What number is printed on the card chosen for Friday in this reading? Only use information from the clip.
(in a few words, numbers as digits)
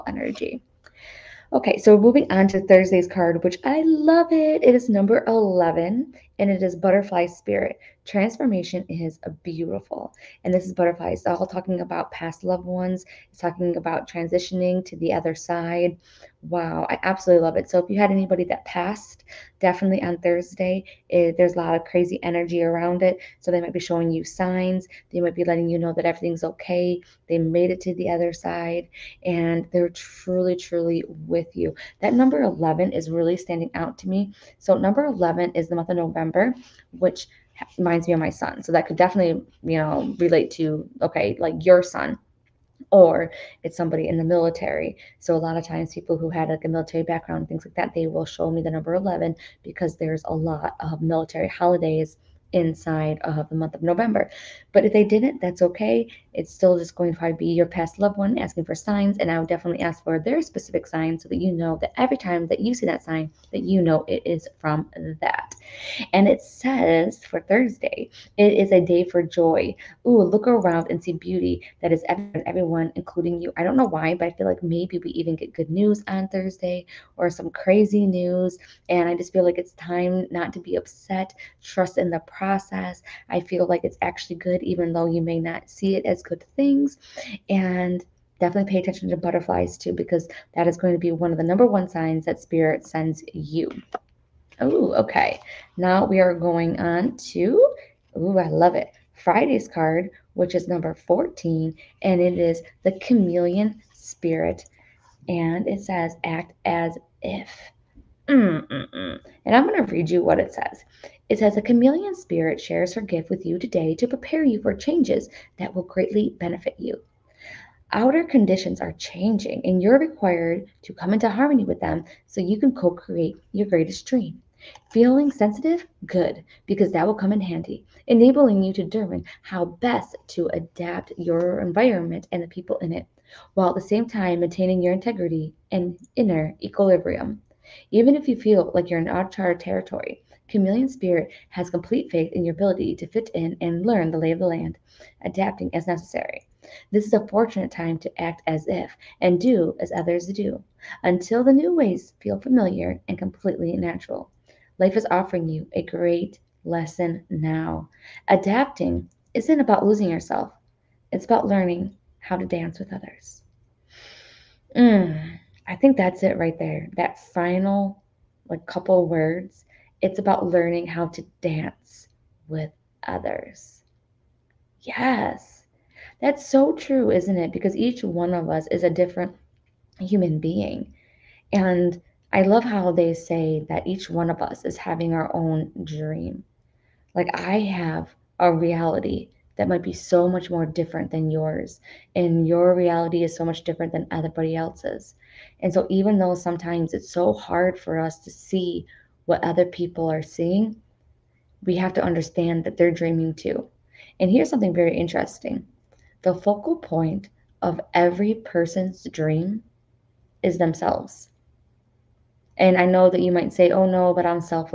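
14.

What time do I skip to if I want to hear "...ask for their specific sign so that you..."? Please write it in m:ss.
0:59.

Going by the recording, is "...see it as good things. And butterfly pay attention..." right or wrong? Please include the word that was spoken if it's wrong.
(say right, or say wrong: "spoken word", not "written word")
wrong: "definitely", not "butterfly".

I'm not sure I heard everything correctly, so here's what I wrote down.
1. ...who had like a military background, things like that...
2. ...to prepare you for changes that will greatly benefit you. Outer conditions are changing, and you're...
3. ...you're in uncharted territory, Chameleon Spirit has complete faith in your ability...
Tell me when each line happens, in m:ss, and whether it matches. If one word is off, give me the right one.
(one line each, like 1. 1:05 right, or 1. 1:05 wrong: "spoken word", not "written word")
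1. 0:46 right
2. 1:53 right
3. 2:18 right.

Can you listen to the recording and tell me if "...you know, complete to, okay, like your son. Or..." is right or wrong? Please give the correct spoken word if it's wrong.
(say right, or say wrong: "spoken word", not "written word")
wrong: "relate", not "complete".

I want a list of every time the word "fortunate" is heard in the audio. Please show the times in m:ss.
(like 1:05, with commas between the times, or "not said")
2:27.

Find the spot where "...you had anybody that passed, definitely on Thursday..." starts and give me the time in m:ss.
0:17.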